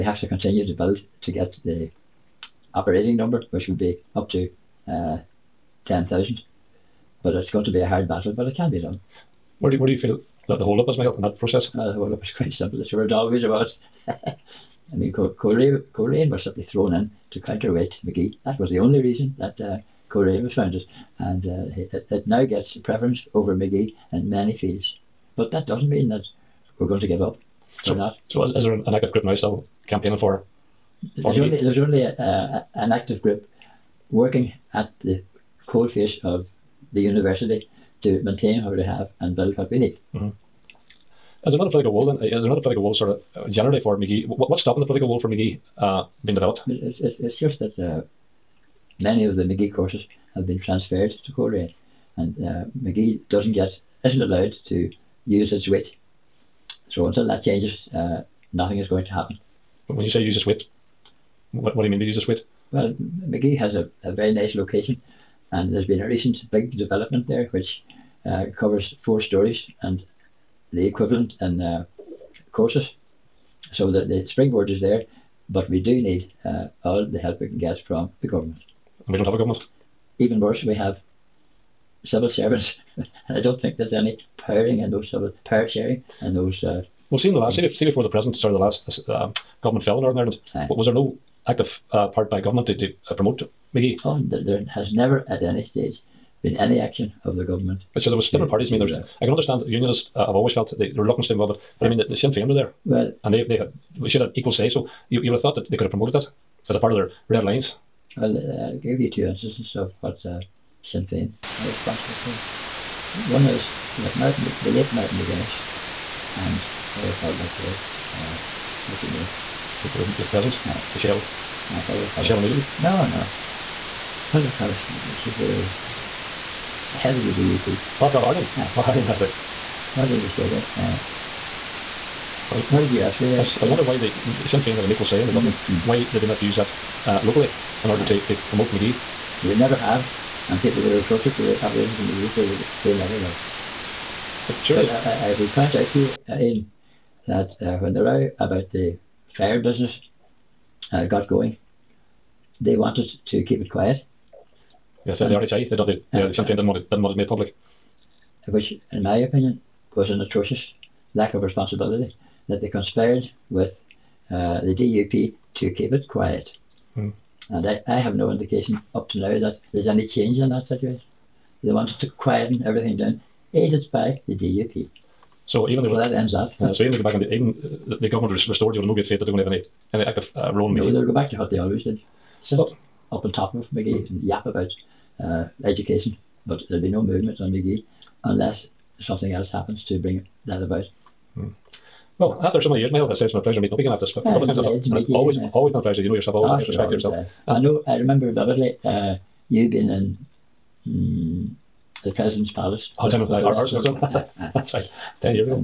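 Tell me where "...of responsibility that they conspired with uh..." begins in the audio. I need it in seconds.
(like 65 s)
161 s.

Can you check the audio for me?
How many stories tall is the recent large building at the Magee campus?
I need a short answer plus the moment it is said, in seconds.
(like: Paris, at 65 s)
4, at 69 s.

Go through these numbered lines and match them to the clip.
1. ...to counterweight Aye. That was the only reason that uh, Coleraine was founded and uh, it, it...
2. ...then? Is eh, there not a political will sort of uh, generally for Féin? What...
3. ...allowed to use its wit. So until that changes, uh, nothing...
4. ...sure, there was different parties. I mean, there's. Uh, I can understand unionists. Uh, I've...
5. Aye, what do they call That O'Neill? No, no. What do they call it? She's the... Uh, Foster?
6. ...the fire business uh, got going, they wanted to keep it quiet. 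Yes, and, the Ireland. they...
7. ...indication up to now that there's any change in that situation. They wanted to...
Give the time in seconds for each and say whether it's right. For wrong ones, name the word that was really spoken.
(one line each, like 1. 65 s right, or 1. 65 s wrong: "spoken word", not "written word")
1. 17 s wrong: "Magee", not "Aye"
2. 42 s wrong: "Magee", not "Féin"
3. 54 s right
4. 98 s right
5. 121 s wrong: "Michelle", not "That"
6. 148 s wrong: "RHI", not "Ireland"
7. 168 s right.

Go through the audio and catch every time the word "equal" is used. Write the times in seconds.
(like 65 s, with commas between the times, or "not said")
104 s, 134 s.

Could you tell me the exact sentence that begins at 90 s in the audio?
was there no active uh, part by government to, to uh, promote Magee?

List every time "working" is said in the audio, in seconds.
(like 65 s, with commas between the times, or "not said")
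34 s.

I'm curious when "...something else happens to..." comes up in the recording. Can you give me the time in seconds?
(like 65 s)
189 s.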